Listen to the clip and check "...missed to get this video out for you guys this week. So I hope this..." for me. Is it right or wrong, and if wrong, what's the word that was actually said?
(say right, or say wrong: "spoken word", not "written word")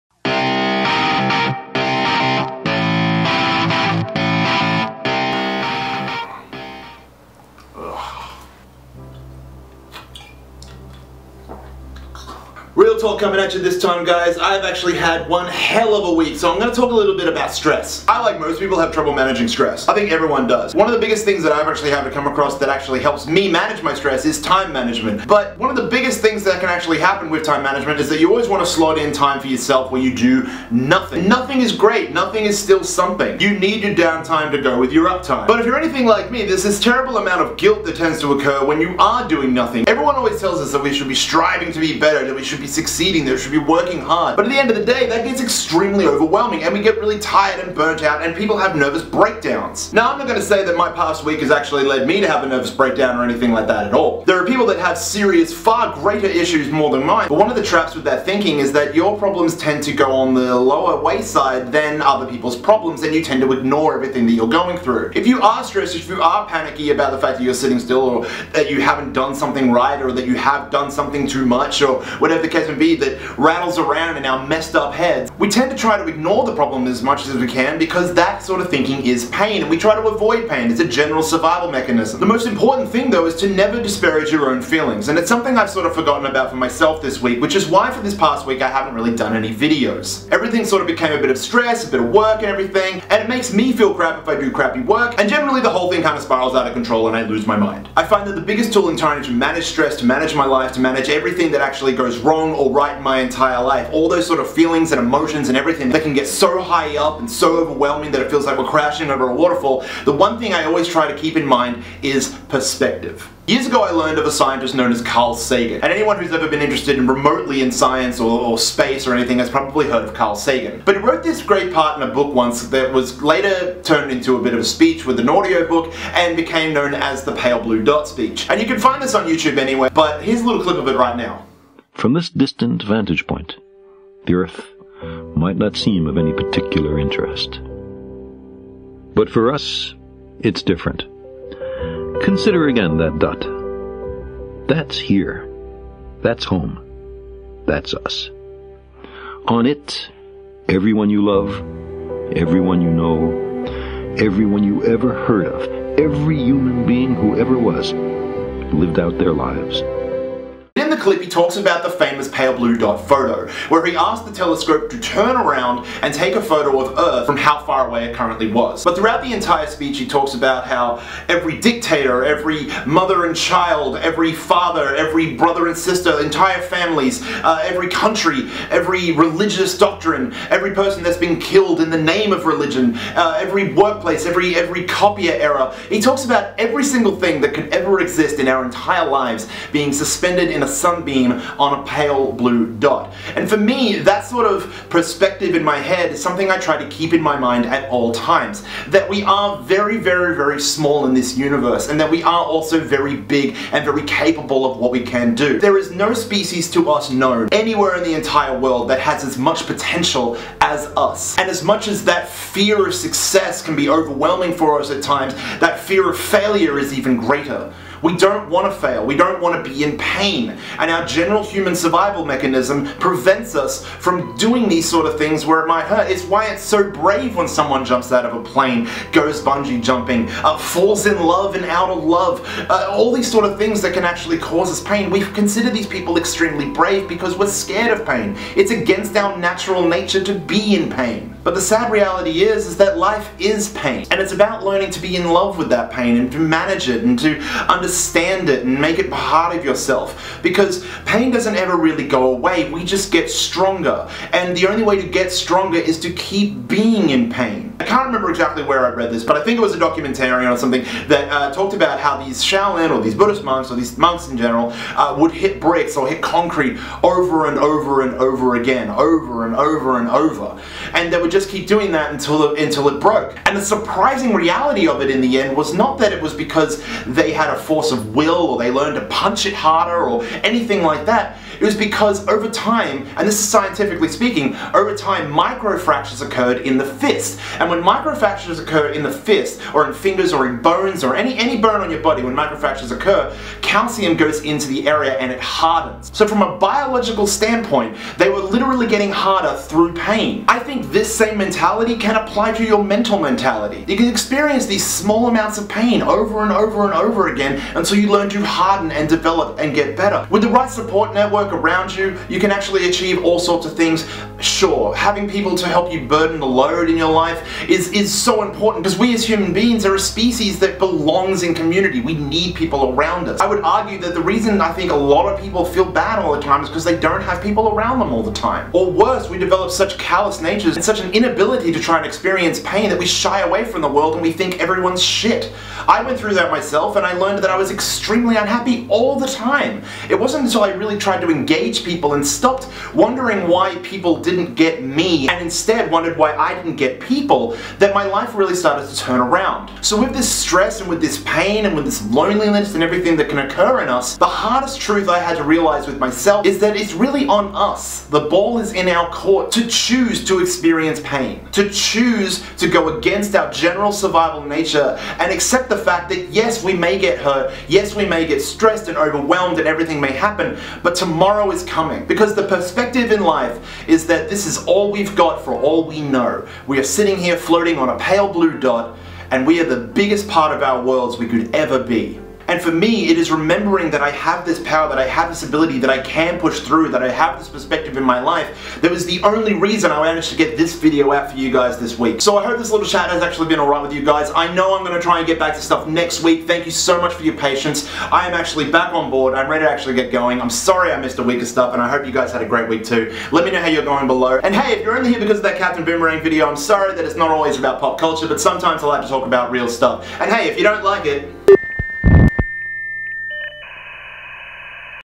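wrong: "managed", not "missed".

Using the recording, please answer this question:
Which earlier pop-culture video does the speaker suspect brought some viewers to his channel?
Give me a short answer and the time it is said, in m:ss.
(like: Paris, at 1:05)
Captain Boomerang, at 6:45.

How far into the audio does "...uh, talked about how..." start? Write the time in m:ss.
4:21.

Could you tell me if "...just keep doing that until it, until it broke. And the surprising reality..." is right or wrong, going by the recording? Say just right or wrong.
right.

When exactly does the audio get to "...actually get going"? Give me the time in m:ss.
6:39.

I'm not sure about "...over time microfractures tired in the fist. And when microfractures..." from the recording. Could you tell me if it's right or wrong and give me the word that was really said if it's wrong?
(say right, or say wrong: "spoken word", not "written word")
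wrong: "occurred", not "tired".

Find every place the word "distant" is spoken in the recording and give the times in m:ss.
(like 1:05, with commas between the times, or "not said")
2:12.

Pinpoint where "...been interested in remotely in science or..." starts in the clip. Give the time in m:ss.
1:56.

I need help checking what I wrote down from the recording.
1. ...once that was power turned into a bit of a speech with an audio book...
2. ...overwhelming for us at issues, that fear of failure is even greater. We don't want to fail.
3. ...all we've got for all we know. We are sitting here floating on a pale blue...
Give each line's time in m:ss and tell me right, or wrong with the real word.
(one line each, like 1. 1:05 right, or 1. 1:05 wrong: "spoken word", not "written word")
1. 2:02 wrong: "later", not "power"
2. 3:33 wrong: "times", not "issues"
3. 6:14 right.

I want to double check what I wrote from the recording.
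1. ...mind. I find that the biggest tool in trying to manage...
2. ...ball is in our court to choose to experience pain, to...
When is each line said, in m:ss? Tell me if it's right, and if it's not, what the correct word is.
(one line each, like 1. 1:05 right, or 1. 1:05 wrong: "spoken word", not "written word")
1. 1:37 right
2. 5:58 right.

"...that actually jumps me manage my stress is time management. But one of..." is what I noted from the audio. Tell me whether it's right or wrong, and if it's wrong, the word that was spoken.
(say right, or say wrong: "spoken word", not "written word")
wrong: "helps", not "jumps".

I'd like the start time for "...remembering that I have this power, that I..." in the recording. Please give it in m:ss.
6:23.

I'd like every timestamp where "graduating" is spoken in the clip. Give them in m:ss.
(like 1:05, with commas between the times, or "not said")
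not said.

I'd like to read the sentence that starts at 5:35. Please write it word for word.
I went through that myself and I learned that I was extremely unhappy all the time.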